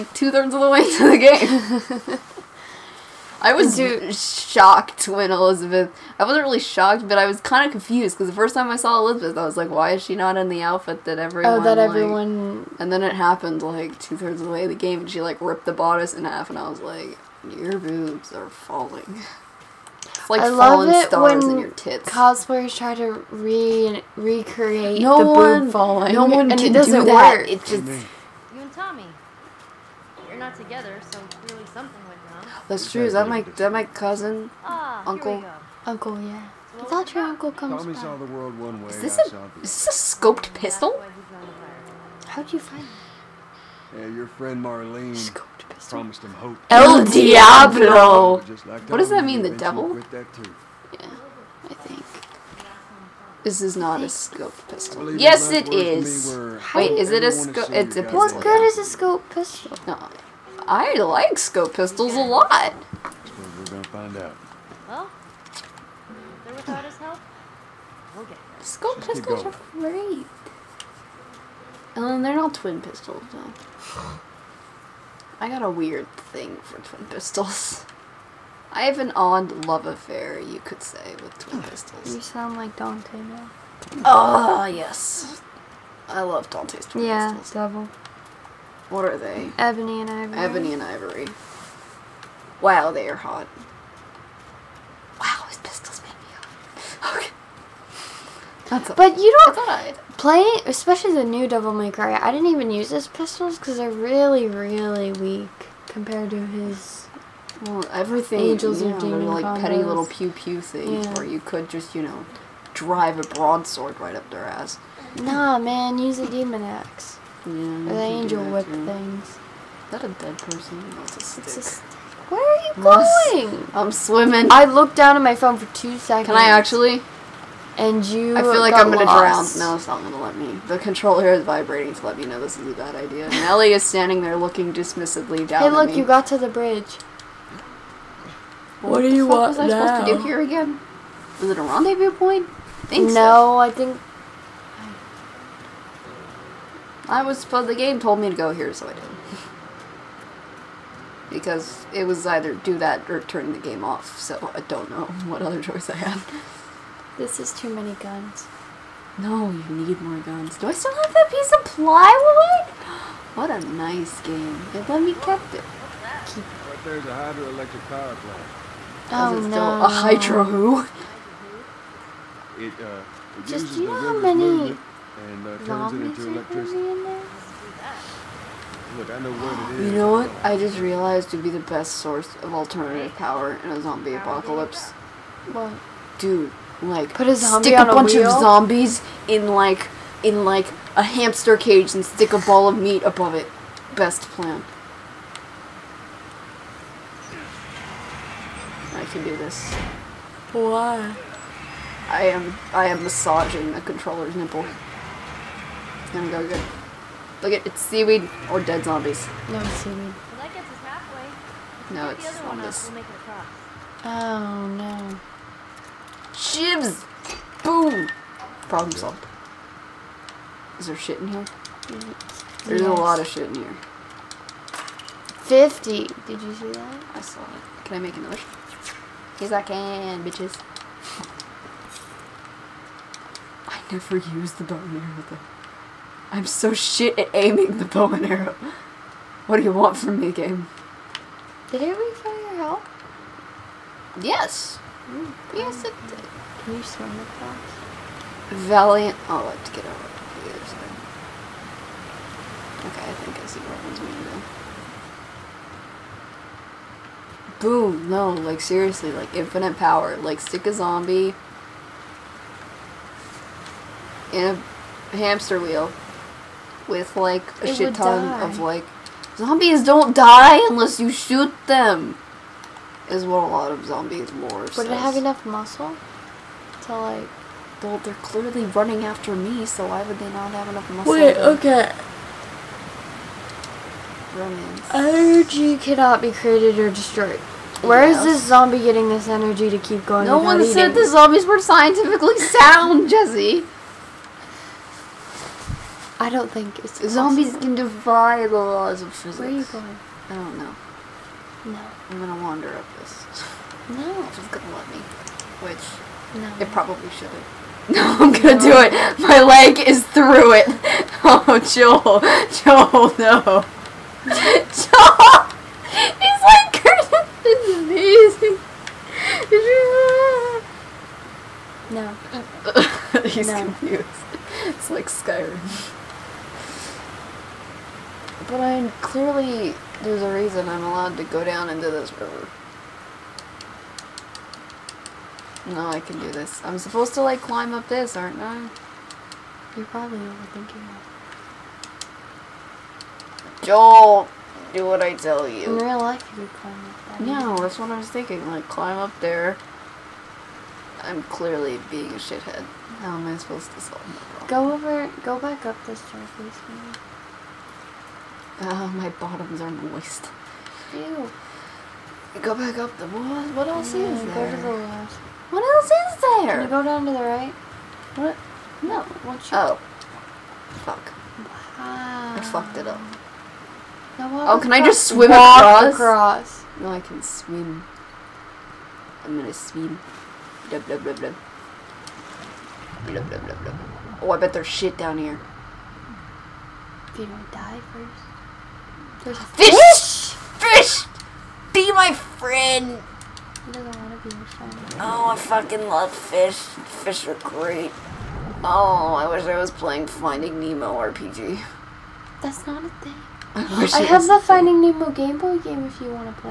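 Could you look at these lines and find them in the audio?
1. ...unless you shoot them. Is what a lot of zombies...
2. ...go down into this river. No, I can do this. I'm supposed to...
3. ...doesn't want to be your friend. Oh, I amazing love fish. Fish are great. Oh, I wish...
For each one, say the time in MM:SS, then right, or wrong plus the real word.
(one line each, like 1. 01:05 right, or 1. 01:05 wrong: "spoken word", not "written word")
1. 04:30 right
2. 05:31 right
3. 06:33 wrong: "fucking", not "amazing".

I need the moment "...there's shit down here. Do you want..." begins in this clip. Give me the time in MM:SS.
06:24.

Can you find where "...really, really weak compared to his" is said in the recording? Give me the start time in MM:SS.
01:43.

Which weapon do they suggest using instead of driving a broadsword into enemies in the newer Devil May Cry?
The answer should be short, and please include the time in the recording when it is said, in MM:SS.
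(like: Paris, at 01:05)
demon axe, at 01:56.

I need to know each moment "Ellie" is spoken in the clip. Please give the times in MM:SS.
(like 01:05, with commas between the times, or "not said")
02:13.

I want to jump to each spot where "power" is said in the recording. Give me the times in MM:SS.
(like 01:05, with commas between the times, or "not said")
02:47, 03:03, 04:19.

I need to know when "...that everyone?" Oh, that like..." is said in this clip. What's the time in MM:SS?
00:11.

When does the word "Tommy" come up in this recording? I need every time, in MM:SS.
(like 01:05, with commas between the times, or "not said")
00:28, 00:37.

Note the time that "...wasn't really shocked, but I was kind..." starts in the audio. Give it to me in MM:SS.
00:06.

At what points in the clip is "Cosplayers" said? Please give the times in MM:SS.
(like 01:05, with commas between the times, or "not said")
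00:22.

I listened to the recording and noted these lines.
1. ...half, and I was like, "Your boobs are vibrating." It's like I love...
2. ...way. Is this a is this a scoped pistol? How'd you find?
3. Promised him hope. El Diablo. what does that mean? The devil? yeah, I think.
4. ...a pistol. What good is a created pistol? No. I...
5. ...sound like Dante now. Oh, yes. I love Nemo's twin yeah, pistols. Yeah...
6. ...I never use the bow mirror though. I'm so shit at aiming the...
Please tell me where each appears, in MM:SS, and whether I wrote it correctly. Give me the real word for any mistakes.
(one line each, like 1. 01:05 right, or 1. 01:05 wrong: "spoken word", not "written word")
1. 00:16 wrong: "falling", not "vibrating"
2. 00:38 right
3. 00:45 right
4. 00:57 wrong: "scoped", not "created"
5. 01:22 wrong: "Dante", not "Nemo"
6. 03:53 right.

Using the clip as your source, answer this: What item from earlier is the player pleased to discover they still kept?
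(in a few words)
piece of plywood.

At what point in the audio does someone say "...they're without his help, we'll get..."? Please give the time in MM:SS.
01:06.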